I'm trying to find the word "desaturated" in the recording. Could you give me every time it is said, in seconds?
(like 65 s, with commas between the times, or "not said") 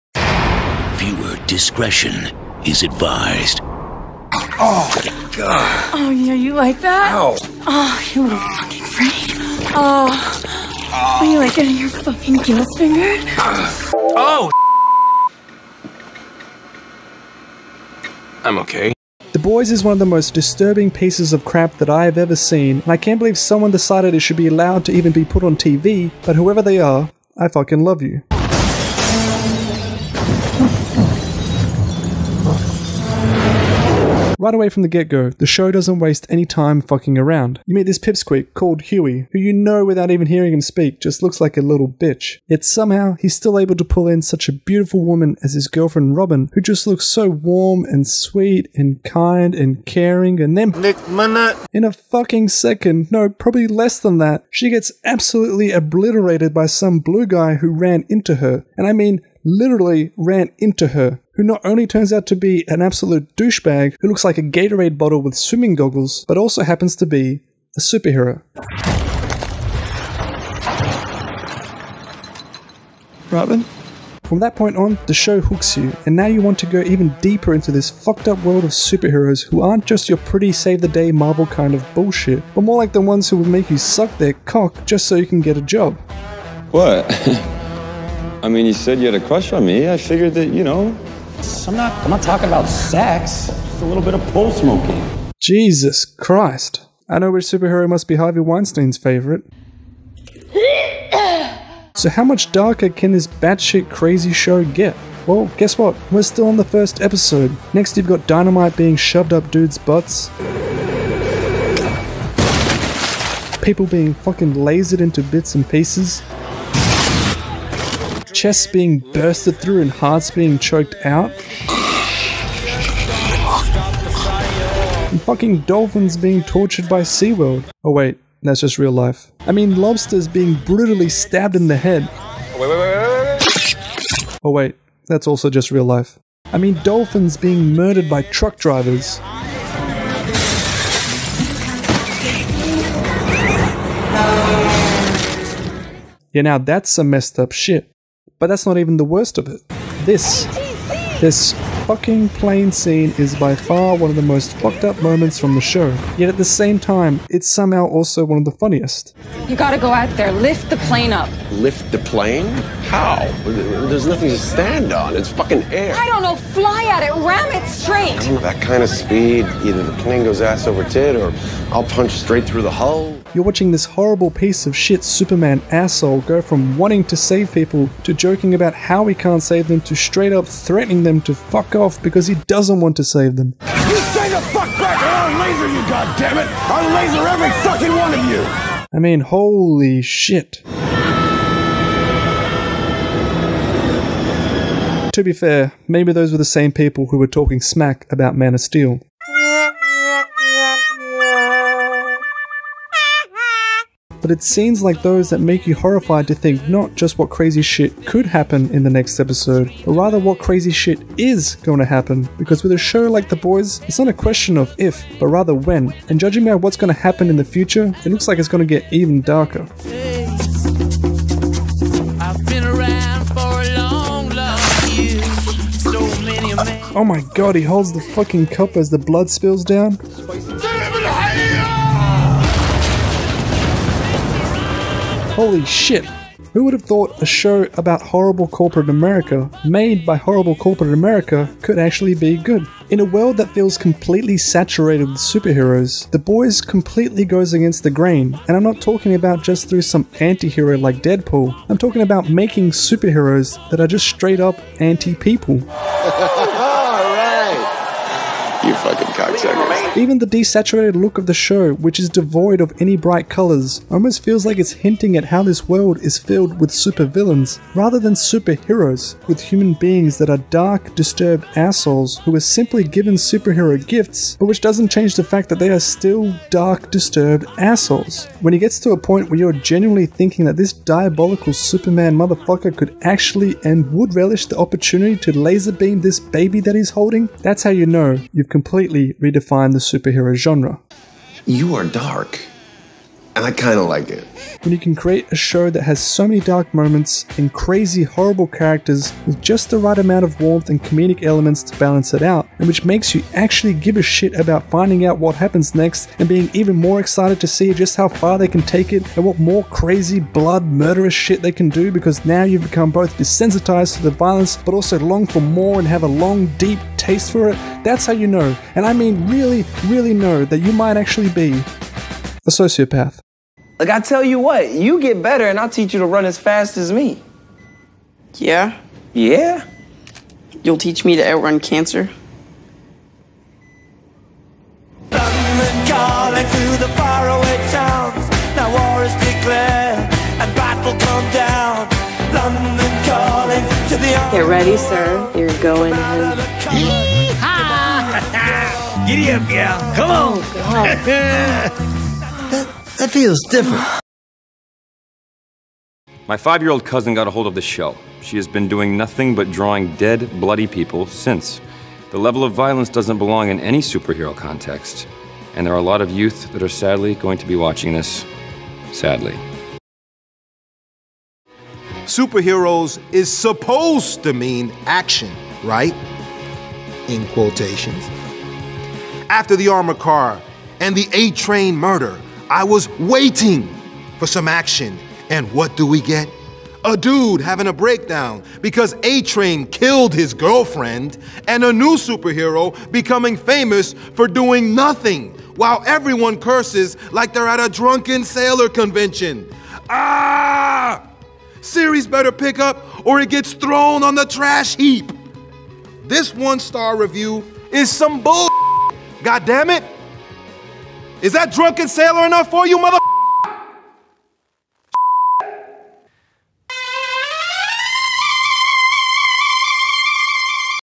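260 s.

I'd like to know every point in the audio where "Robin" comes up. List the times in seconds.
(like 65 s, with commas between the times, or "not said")
46 s, 73 s.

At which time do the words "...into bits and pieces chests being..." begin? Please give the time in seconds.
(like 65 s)
115 s.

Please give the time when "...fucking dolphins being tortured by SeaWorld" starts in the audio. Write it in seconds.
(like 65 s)
125 s.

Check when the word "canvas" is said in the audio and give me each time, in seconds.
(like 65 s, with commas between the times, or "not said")
not said.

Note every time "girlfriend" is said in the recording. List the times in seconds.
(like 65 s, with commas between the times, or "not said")
45 s, 390 s.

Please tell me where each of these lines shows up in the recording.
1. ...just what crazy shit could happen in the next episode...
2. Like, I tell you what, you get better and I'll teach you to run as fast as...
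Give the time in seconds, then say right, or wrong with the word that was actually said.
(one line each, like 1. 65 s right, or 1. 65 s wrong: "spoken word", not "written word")
1. 206 s right
2. 323 s right.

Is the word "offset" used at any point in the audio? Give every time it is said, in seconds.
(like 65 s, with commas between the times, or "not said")
not said.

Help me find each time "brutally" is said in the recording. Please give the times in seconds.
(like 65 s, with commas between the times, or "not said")
130 s.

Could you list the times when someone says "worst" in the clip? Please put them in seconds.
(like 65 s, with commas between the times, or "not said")
149 s.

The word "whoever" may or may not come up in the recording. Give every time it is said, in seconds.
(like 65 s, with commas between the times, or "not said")
26 s.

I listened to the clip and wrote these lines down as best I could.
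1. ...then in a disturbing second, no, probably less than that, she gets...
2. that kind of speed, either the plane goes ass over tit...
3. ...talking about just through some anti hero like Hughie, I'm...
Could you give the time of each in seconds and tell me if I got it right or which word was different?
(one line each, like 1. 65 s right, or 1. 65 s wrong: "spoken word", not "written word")
1. 50 s wrong: "fucking", not "disturbing"
2. 168 s right
3. 248 s wrong: "Deadpool", not "Hughie".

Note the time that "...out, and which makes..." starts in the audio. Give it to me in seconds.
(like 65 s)
302 s.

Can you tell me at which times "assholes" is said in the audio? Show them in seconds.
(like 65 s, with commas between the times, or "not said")
175 s, 271 s, 277 s.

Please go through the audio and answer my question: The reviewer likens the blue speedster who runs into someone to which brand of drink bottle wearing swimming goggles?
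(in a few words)
Gatorade.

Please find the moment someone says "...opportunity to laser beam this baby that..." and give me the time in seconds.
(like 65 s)
284 s.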